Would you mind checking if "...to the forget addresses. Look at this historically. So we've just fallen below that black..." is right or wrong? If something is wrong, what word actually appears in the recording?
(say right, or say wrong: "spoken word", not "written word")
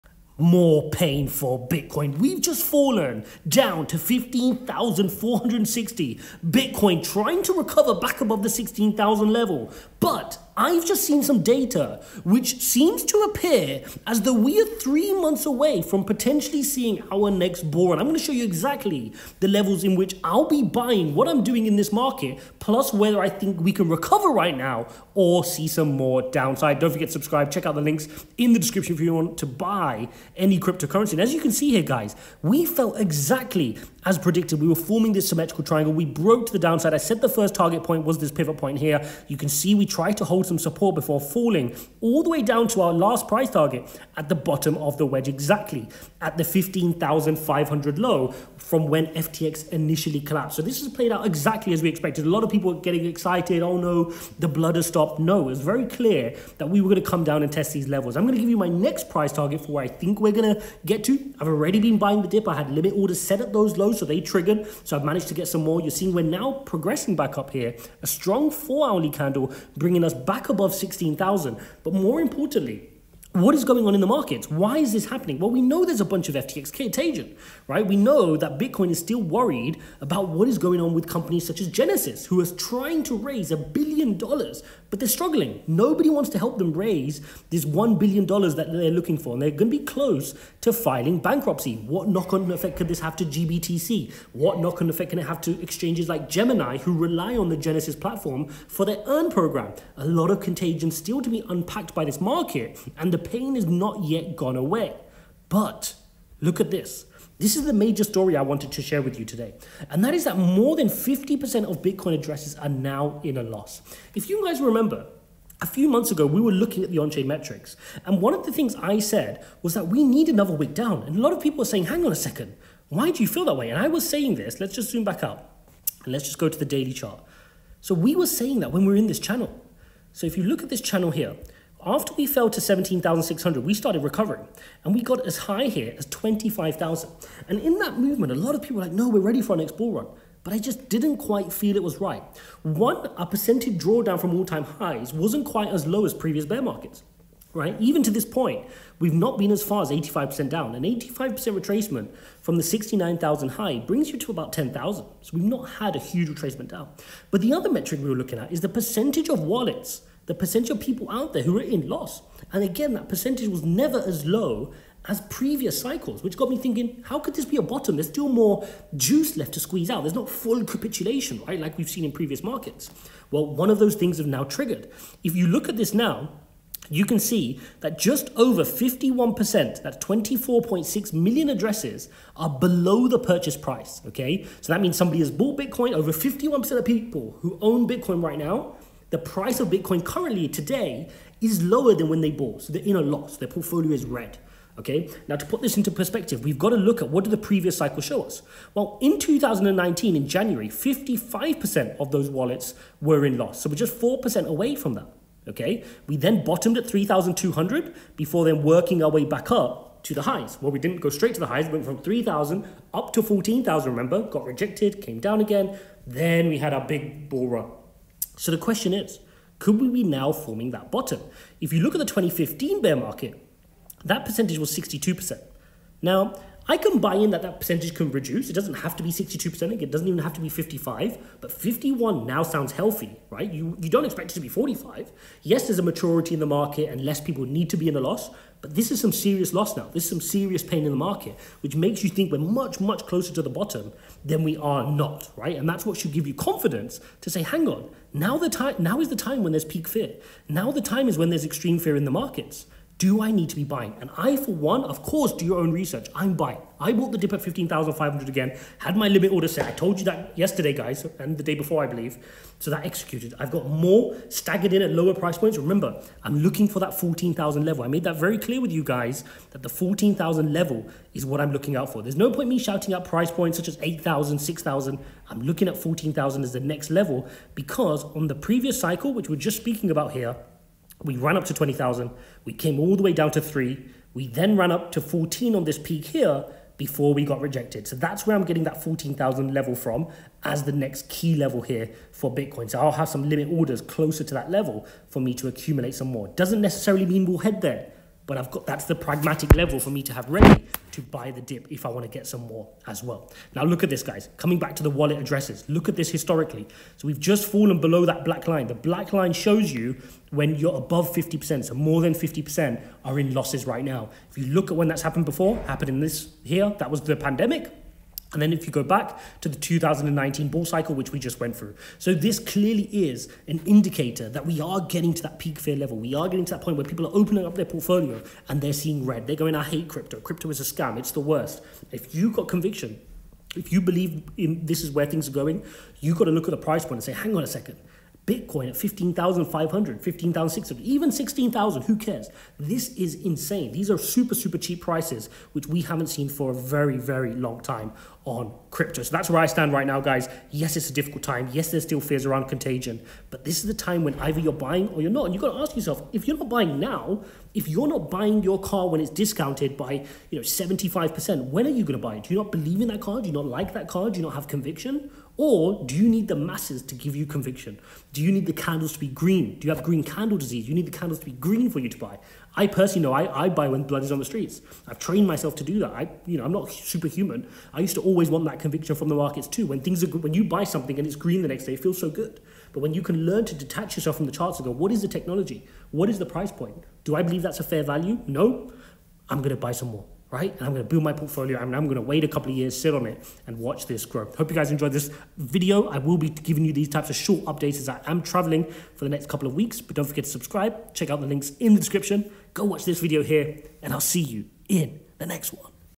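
wrong: "wallet", not "forget".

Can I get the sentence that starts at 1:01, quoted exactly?
I've already been buying the dip.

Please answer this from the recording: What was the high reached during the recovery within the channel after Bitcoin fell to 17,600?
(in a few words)
25,000.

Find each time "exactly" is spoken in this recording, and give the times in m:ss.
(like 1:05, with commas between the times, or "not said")
0:18, 0:32, 0:45, 0:51.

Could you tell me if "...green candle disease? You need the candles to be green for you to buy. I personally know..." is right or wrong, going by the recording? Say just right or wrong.
right.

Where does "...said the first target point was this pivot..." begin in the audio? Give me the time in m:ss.
0:36.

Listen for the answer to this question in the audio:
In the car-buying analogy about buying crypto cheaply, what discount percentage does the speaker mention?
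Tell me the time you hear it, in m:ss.
6:00.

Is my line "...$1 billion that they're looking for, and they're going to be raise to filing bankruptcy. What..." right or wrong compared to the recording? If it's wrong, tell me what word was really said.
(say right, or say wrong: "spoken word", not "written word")
wrong: "close", not "raise".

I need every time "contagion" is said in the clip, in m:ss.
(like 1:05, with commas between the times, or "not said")
1:16, 1:40, 5:52.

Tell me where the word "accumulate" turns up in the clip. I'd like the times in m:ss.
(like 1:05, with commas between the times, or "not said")
4:55.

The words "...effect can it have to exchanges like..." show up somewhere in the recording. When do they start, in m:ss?
1:34.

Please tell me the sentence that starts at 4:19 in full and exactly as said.
I told you that yesterday, guys, and the day before, I believe.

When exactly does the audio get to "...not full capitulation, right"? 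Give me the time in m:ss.
2:50.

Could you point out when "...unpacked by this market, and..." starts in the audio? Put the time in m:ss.
1:41.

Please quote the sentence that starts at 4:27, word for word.
I made that very clear with you guys that the 14,000 level is what I'm looking out for.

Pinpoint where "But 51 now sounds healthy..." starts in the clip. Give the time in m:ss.
3:51.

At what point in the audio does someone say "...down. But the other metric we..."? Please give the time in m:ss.
2:36.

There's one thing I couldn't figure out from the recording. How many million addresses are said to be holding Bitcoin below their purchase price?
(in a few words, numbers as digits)
24.6 million.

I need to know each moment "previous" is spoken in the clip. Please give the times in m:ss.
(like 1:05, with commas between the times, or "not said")
2:26, 2:45, 2:52, 3:17, 4:38.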